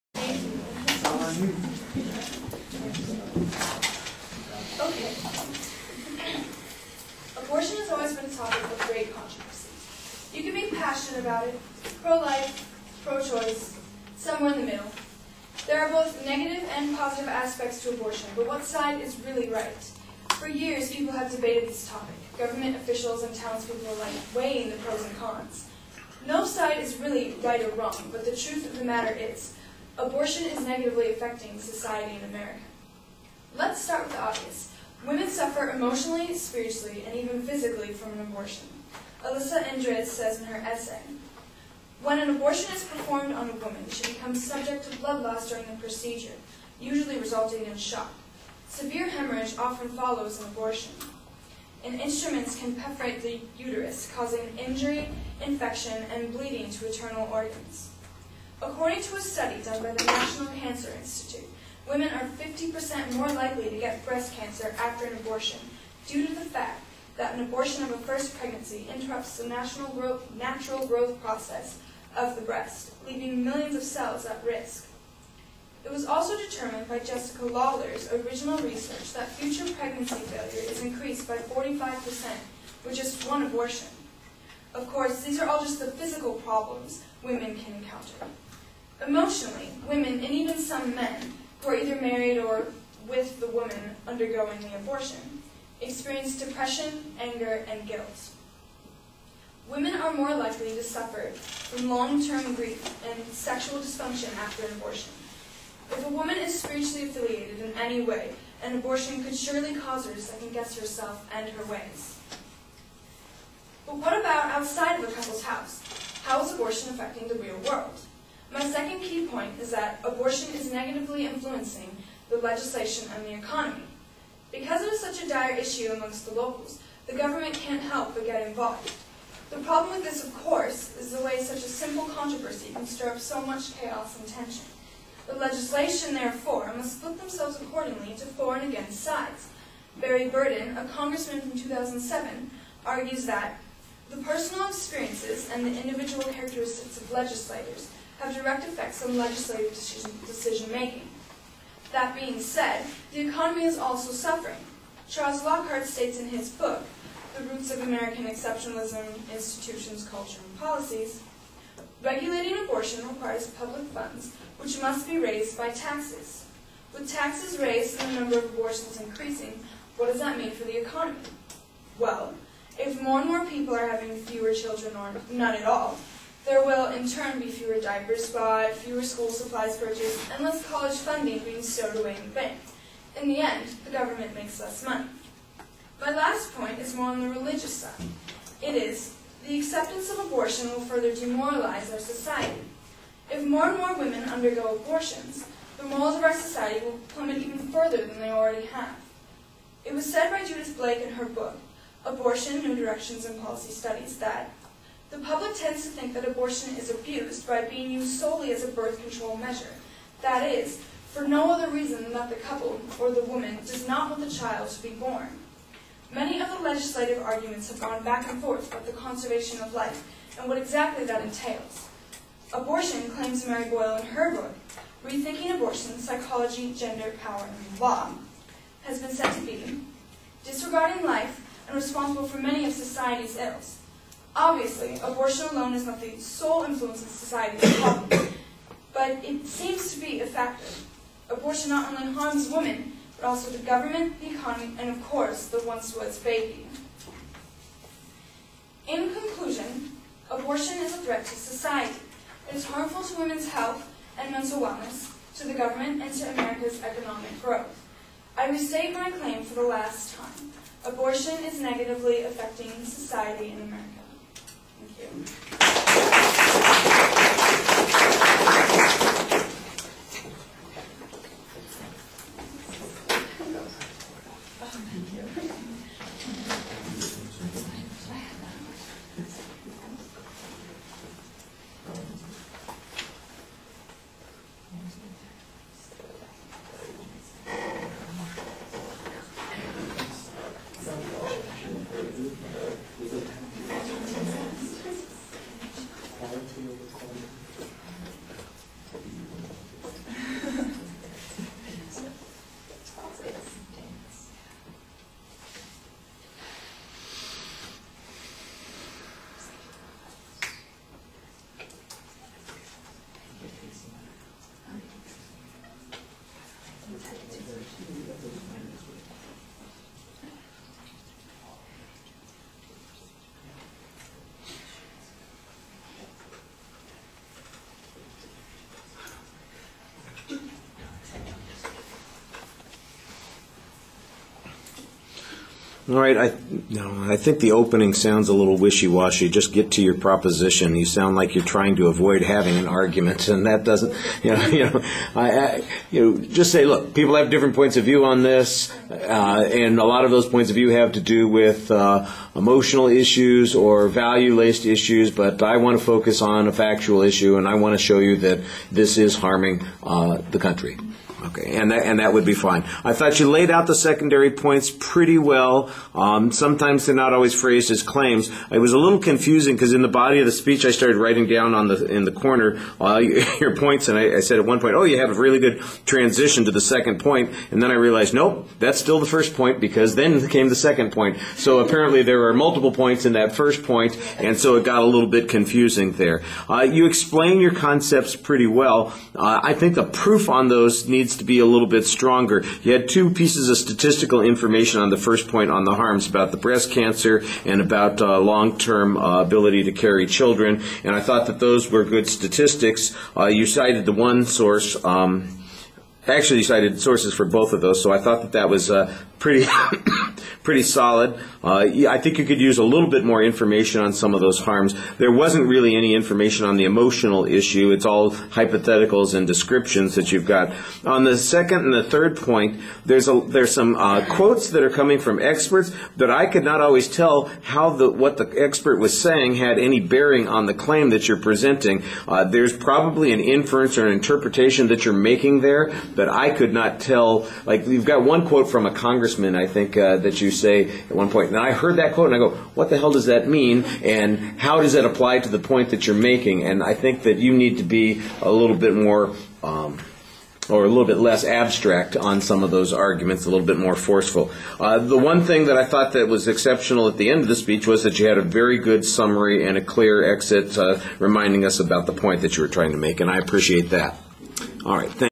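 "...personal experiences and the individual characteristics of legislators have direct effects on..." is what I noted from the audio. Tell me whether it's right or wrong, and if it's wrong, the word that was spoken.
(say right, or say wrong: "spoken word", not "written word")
right.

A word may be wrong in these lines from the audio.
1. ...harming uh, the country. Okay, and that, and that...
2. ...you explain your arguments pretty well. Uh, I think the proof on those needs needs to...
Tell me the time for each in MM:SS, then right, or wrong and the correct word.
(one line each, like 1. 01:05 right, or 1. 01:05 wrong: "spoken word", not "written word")
1. 05:59 right
2. 06:26 wrong: "concepts", not "arguments".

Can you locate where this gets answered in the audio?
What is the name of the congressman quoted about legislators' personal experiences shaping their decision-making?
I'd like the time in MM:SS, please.
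02:19.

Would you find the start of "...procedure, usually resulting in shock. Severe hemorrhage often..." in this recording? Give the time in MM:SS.
00:45.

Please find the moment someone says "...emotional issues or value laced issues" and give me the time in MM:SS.
05:52.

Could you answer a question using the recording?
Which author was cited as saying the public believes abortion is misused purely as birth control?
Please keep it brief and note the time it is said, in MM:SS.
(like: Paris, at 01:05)
Judith Blake, at 03:20.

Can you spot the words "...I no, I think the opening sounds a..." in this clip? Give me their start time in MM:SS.
05:36.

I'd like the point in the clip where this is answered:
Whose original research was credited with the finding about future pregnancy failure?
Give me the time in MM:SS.
01:16.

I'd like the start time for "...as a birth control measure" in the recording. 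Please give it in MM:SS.
03:28.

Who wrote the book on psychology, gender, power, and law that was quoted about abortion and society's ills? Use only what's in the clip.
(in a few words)
Mary Boyle.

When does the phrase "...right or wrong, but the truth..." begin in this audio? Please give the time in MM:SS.
00:27.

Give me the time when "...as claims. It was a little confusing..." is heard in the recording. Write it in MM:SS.
06:07.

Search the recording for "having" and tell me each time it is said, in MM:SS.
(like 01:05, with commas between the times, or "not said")
02:53, 05:42.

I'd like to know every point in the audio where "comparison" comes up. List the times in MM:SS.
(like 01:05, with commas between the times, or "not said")
not said.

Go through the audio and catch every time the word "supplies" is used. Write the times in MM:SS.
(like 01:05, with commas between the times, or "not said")
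02:59.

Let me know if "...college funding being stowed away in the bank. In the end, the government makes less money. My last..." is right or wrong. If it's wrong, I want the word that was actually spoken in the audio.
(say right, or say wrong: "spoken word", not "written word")
right.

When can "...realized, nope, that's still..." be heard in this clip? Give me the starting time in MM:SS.
06:17.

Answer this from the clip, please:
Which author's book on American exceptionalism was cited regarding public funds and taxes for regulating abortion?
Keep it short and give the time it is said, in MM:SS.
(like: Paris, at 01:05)
Charles Lockhart, at 02:35.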